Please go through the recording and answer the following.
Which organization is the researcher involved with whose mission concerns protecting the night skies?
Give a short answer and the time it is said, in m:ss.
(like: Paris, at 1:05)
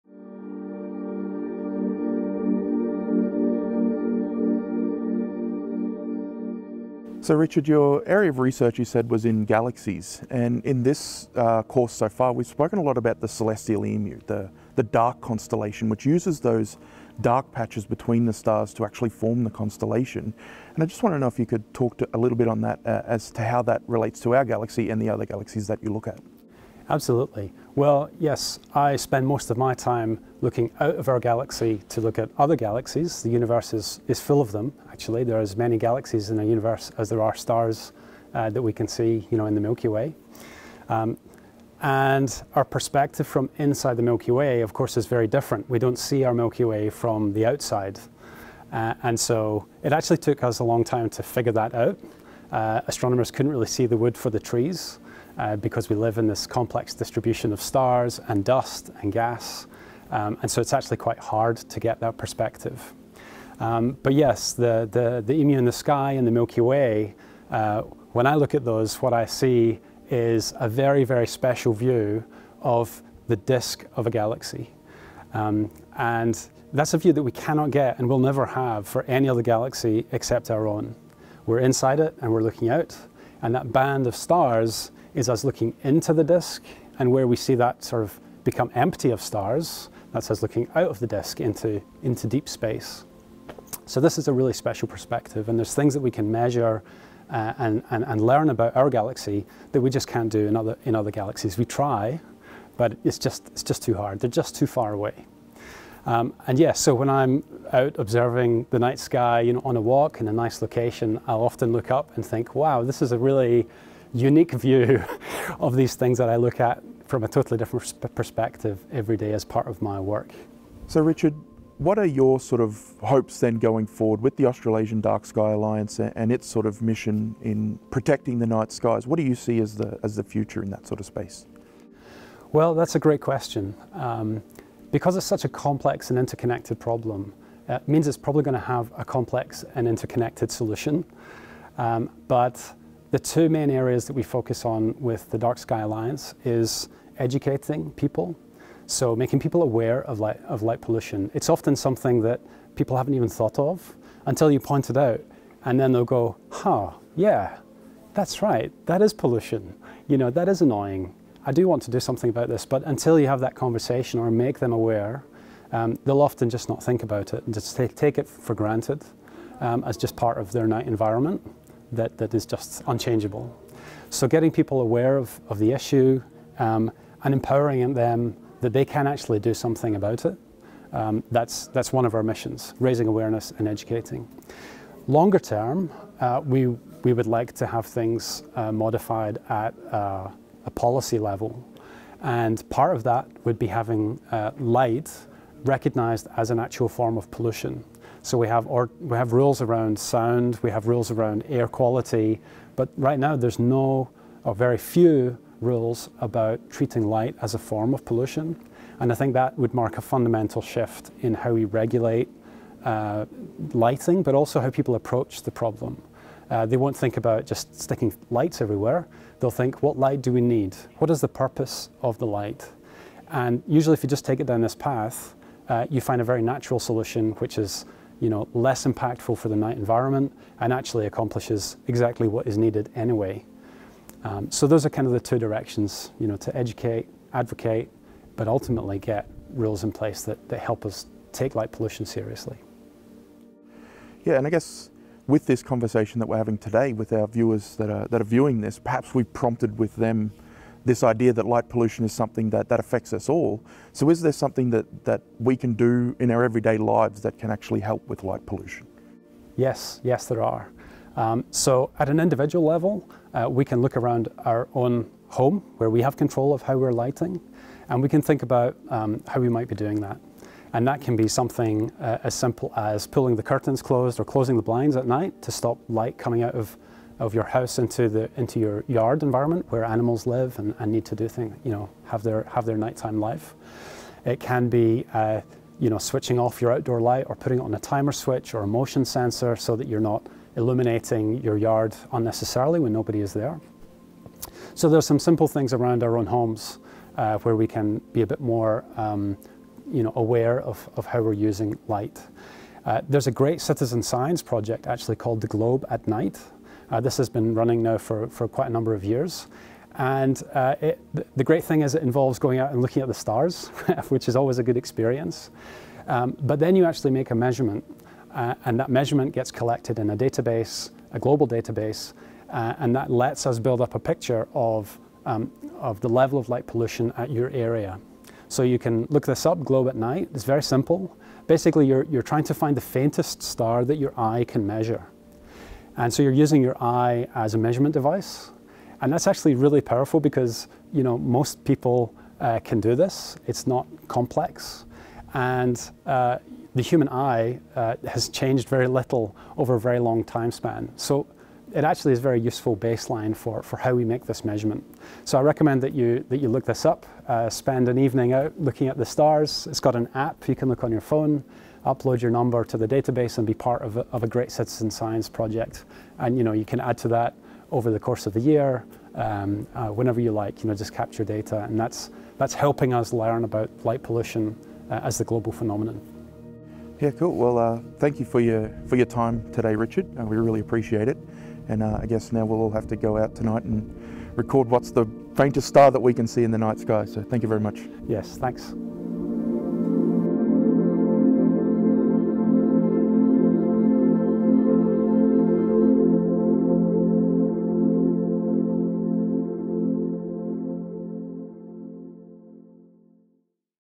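Australasian Dark Sky Alliance, at 2:04.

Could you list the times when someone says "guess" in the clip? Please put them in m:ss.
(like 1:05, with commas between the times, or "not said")
4:04, 6:22.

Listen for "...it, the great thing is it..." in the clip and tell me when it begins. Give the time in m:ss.
5:10.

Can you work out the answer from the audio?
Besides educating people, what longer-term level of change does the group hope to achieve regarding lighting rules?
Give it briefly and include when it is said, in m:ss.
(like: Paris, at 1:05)
Policy level, at 3:10.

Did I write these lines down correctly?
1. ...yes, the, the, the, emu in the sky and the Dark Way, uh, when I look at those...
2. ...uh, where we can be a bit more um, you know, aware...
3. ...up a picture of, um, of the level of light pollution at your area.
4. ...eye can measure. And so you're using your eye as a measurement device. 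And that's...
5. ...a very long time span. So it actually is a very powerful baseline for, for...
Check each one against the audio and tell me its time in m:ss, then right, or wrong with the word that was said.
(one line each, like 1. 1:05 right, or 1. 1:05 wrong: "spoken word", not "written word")
1. 1:04 wrong: "Milky", not "Dark"
2. 4:57 right
3. 5:23 right
4. 5:34 right
5. 5:49 wrong: "useful", not "powerful".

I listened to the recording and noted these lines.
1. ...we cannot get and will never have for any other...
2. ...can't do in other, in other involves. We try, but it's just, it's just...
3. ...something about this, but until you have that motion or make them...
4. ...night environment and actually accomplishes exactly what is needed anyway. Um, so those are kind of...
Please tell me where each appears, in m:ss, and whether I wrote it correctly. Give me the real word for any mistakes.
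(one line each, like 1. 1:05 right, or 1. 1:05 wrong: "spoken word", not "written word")
1. 1:17 right
2. 1:40 wrong: "galaxies", not "involves"
3. 2:41 wrong: "conversation", not "motion"
4. 3:49 right.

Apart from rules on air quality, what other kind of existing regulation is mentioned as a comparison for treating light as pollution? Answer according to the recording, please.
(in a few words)
Sound.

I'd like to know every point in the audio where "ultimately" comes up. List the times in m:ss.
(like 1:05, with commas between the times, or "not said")
3:58.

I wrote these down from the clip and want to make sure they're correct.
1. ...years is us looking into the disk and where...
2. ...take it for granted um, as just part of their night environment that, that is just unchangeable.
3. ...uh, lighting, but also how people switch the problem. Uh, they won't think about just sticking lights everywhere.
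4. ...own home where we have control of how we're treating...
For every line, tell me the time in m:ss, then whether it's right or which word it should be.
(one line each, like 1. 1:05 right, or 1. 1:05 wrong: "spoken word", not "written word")
1. 1:24 wrong: "stars", not "years"
2. 2:47 right
3. 3:32 wrong: "approach", not "switch"
4. 4:24 wrong: "lighting", not "treating".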